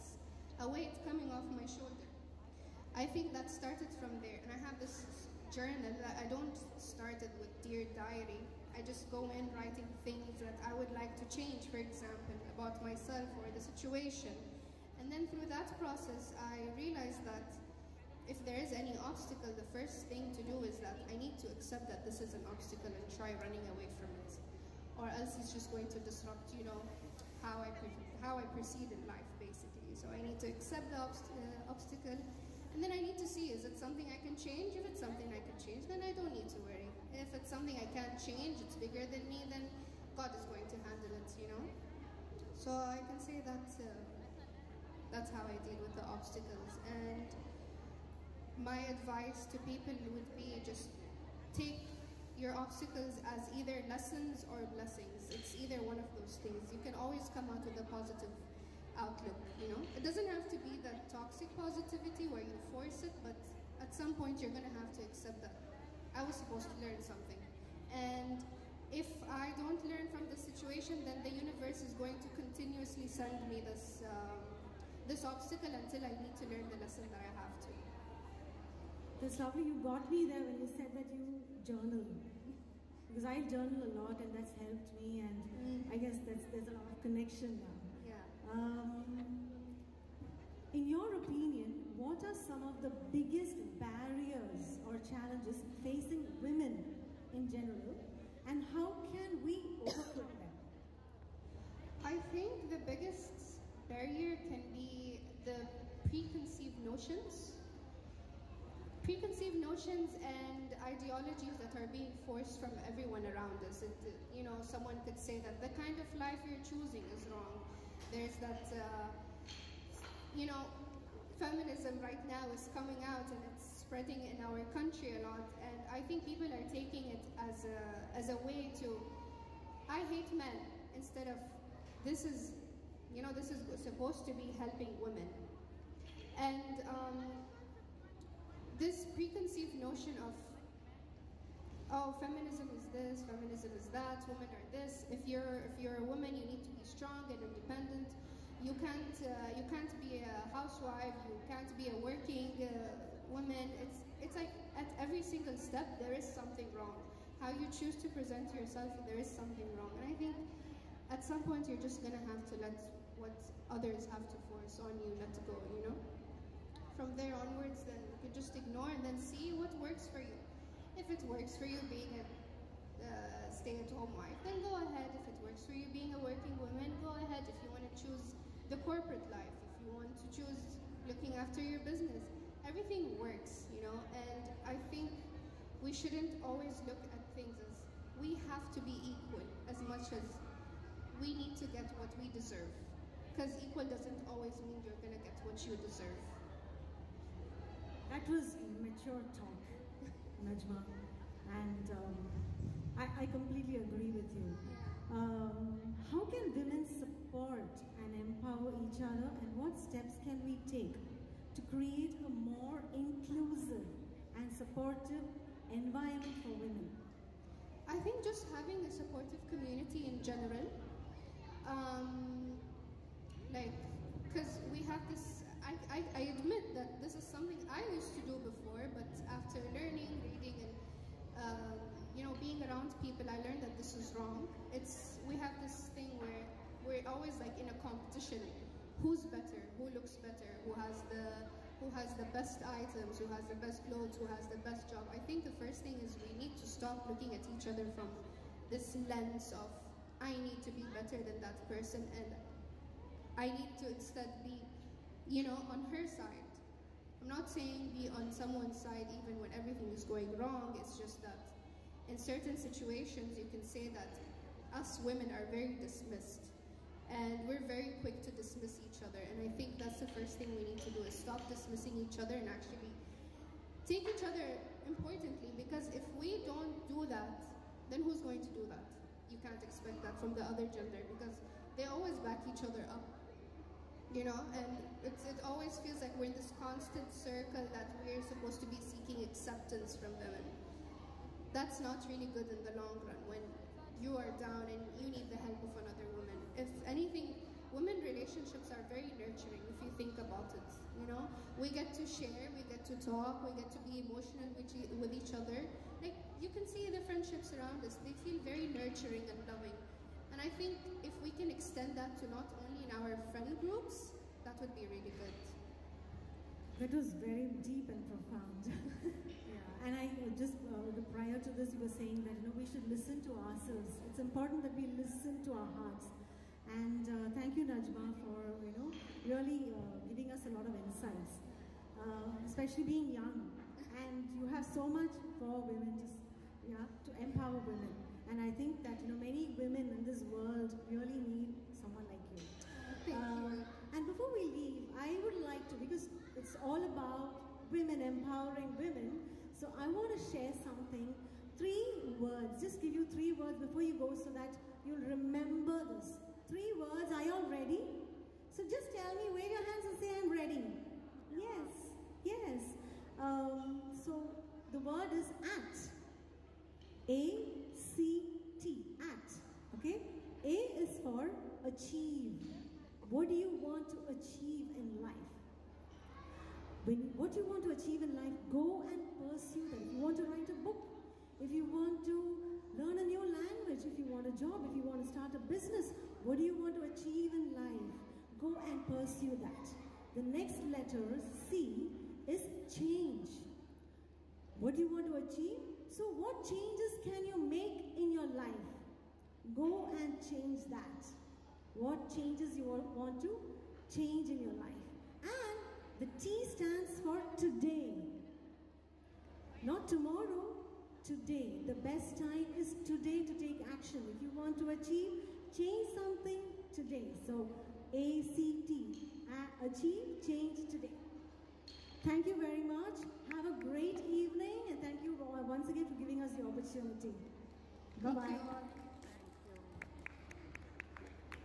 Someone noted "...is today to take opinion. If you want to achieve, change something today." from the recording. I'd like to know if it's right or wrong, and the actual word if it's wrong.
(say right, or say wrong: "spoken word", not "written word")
wrong: "action", not "opinion".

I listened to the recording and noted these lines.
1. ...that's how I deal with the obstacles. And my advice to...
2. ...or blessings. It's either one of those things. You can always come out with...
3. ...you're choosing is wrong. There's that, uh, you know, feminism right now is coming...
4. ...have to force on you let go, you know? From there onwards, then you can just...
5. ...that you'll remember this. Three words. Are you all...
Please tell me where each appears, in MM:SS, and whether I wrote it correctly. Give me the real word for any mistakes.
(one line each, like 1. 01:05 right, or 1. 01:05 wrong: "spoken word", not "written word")
1. 00:45 right
2. 00:54 right
3. 01:56 right
4. 02:44 right
5. 05:54 right.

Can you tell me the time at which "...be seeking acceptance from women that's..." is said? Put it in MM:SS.
04:48.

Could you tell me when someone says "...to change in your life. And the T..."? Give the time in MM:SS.
06:43.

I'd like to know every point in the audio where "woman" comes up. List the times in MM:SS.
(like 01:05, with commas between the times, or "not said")
02:26, 02:33, 02:56, 04:56.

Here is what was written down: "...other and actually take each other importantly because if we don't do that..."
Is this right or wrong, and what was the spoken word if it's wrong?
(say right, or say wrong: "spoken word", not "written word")
right.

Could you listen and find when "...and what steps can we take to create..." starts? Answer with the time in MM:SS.
03:29.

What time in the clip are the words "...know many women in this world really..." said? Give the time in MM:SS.
05:39.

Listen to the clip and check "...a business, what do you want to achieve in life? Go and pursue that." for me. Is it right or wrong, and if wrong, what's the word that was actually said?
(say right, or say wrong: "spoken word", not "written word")
right.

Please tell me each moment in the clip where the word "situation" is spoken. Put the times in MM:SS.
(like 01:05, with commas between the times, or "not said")
00:13, 01:10, 04:22.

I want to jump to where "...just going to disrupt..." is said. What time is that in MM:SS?
00:25.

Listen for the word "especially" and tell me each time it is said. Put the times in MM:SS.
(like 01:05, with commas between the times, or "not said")
05:32.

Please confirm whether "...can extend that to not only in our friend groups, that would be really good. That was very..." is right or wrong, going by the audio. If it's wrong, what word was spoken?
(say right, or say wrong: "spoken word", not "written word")
right.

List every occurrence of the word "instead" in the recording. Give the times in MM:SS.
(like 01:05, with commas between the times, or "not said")
02:10, 04:13.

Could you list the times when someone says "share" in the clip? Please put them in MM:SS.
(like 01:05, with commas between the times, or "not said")
05:02, 05:50.